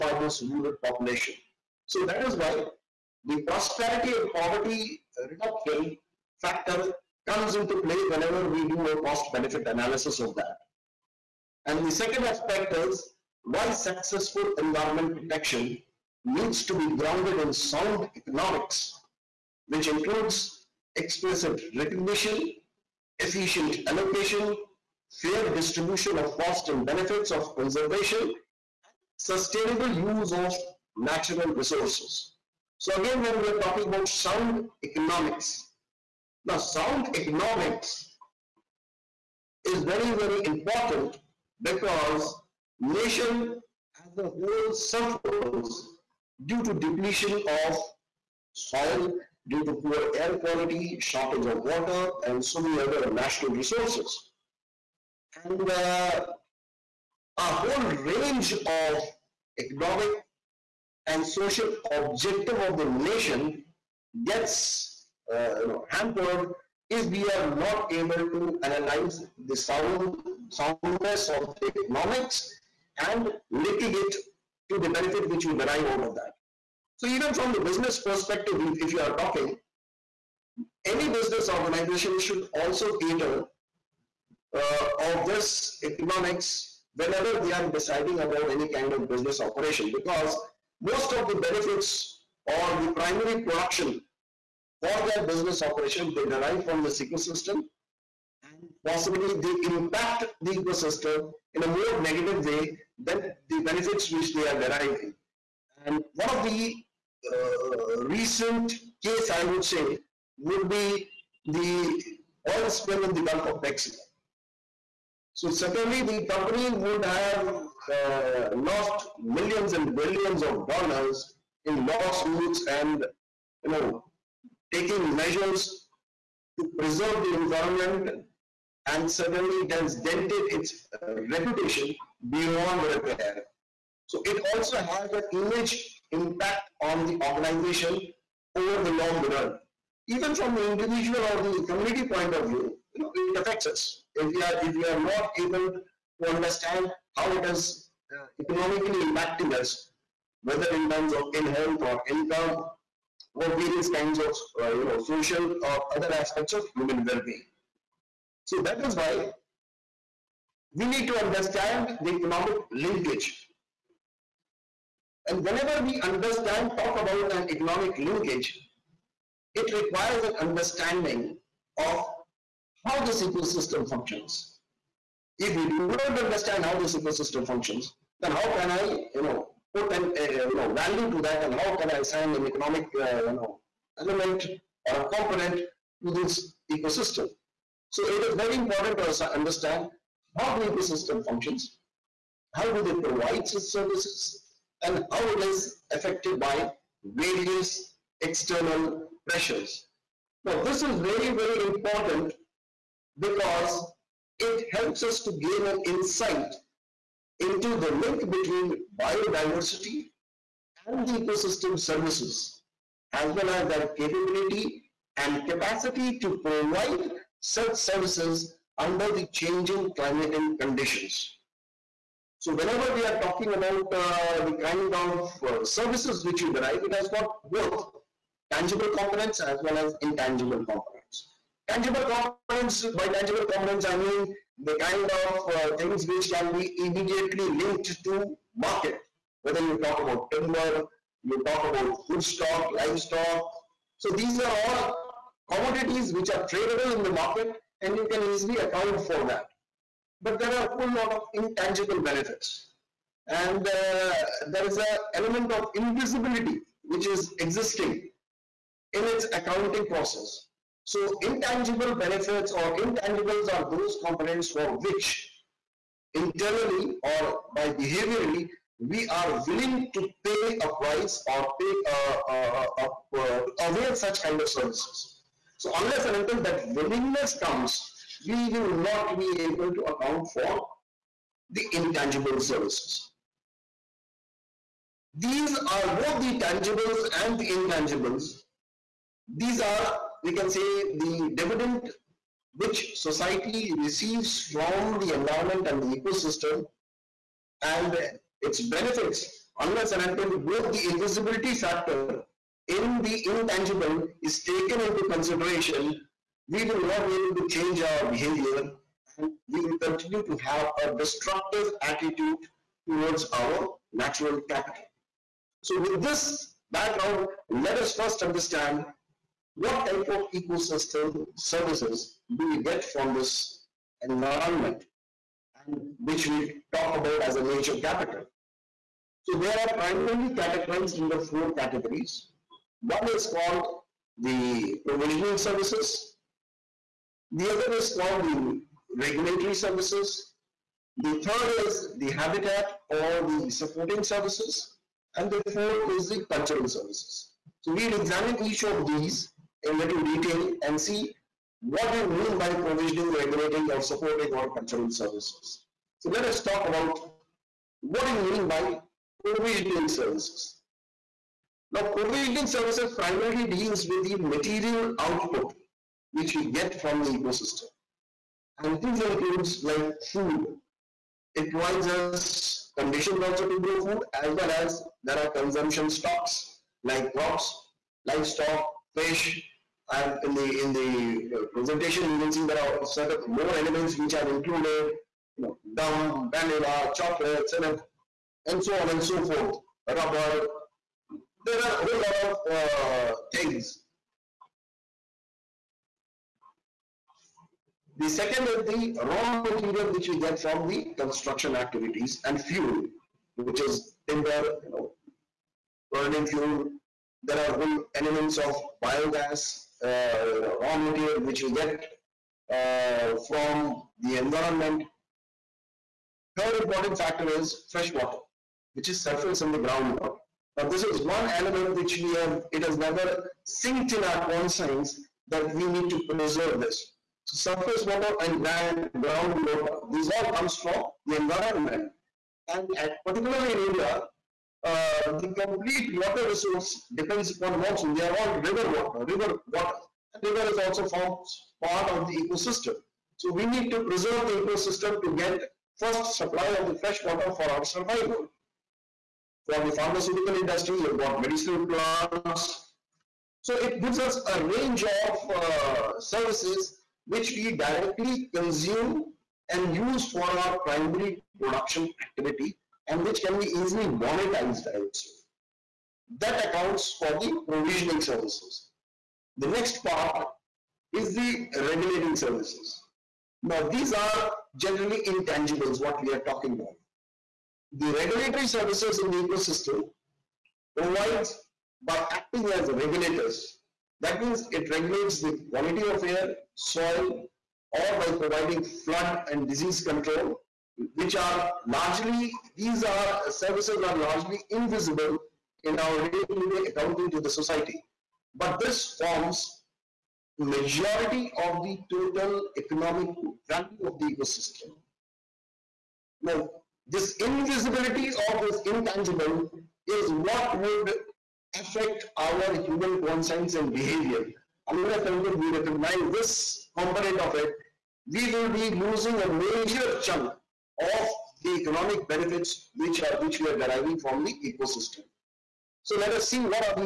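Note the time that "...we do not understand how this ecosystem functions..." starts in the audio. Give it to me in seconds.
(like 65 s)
175 s.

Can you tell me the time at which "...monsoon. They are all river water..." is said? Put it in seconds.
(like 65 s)
437 s.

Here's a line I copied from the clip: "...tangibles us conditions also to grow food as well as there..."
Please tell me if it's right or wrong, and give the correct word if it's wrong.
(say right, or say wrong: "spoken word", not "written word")
wrong: "provides", not "tangibles".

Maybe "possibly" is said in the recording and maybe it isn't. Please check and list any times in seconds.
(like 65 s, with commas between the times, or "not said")
98 s.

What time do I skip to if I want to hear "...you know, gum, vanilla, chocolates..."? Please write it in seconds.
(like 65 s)
385 s.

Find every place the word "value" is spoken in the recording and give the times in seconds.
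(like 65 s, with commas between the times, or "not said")
180 s, 503 s.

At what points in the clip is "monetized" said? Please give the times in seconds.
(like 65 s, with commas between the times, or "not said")
463 s.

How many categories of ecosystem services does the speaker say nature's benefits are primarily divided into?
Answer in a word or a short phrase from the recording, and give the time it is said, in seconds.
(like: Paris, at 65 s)
4, at 331 s.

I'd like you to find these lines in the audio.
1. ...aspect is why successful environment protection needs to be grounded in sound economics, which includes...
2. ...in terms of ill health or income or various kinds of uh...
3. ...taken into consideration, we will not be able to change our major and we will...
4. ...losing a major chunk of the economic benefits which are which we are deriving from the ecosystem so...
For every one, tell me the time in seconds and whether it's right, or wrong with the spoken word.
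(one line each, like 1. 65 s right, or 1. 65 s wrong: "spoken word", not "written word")
1. 12 s right
2. 150 s right
3. 304 s wrong: "behavior", not "major"
4. 518 s right.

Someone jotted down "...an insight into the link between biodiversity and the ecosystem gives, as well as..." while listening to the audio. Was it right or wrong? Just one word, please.
wrong.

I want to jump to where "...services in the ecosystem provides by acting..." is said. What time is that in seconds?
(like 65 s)
478 s.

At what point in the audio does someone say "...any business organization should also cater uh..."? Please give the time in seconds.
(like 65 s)
80 s.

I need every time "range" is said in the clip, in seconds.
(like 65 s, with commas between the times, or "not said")
57 s, 454 s.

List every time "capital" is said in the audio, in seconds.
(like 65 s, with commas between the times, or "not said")
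314 s, 327 s.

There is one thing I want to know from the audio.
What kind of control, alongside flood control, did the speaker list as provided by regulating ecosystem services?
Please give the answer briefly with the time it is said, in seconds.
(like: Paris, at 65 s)
Disease control, at 489 s.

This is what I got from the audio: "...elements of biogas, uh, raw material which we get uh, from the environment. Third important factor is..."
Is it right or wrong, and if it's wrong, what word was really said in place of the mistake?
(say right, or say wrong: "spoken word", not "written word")
right.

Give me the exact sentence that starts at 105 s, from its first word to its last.
And one of the uh, recent case, I would say, would be the oil spill in the Gulf of Mexico.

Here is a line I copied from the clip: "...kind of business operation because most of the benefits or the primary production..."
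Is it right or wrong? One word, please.
right.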